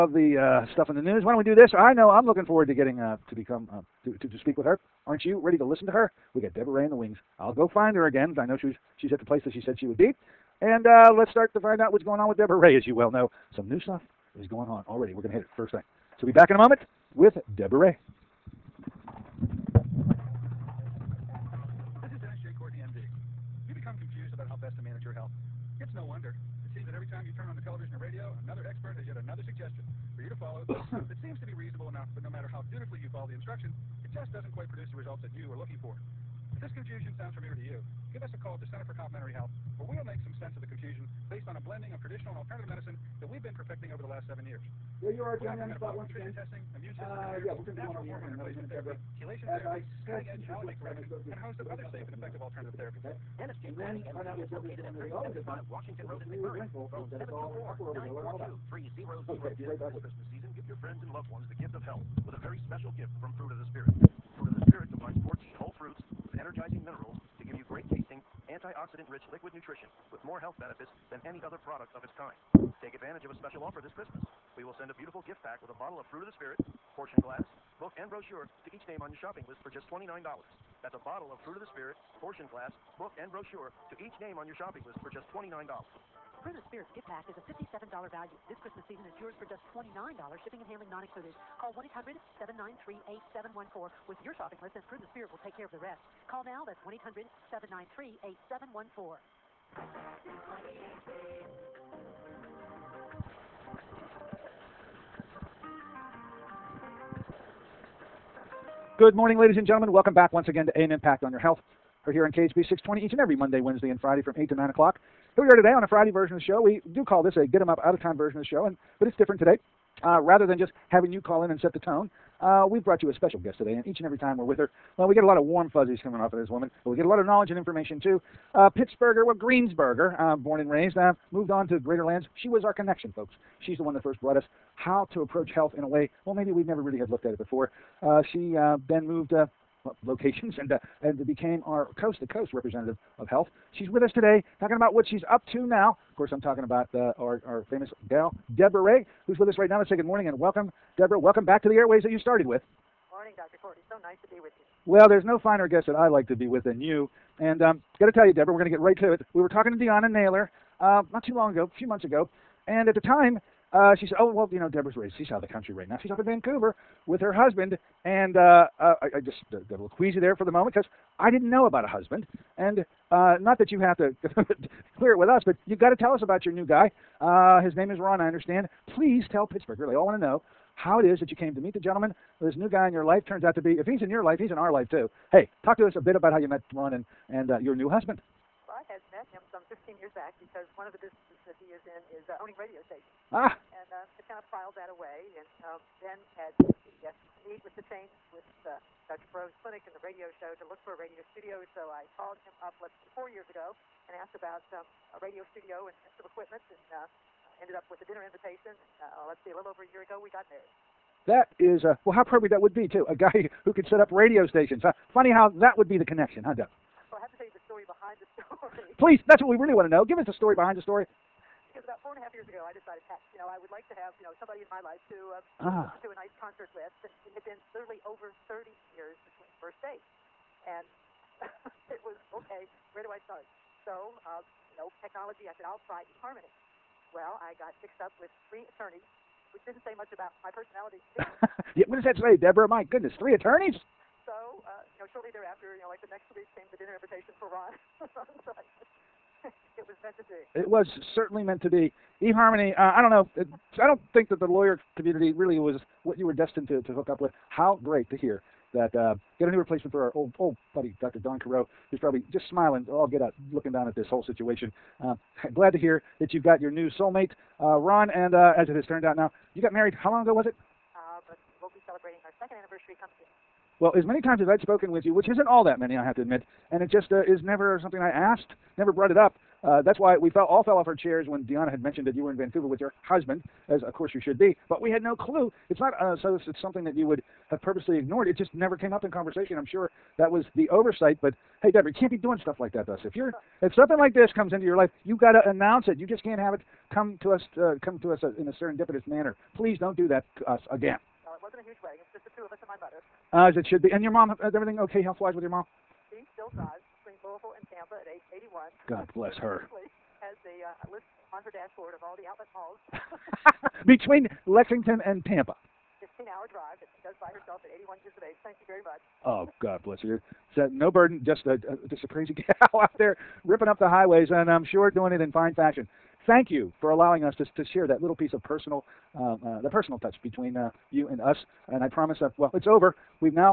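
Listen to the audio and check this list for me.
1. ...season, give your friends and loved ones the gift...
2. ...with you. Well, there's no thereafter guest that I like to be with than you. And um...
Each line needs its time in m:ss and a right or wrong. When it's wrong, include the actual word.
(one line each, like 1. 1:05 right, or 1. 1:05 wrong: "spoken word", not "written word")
1. 1:00 right
2. 2:34 wrong: "finer", not "thereafter".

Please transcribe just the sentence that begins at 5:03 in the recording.
And your mom, uh, is everything okay health-wise with your mom?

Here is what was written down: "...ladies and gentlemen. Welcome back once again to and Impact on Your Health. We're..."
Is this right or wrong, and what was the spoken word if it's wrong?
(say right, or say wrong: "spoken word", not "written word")
right.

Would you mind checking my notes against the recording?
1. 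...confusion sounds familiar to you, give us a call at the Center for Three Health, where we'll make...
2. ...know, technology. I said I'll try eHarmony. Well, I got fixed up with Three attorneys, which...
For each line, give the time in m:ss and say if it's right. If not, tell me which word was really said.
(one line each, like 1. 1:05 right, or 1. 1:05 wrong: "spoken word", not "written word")
1. 0:36 wrong: "Complementary", not "Three"
2. 3:54 right.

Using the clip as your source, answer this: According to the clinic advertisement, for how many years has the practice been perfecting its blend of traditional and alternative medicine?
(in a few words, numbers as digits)
7.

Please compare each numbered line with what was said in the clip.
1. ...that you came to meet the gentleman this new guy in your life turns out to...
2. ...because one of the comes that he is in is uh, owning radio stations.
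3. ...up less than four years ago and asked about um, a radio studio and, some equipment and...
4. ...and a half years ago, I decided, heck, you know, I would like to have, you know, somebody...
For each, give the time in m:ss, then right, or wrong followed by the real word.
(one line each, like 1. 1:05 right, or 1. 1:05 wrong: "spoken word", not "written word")
1. 3:01 right
2. 3:10 wrong: "businesses", not "comes"
3. 3:22 right
4. 3:42 right.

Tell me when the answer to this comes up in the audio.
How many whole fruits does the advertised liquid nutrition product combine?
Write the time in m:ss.
1:05.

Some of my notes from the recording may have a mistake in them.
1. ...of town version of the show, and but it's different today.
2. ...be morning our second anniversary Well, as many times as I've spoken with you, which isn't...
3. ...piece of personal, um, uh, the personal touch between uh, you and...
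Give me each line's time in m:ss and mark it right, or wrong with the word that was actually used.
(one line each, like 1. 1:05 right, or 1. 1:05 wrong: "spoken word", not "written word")
1. 1:57 right
2. 4:31 wrong: "celebrating", not "morning"
3. 5:28 right.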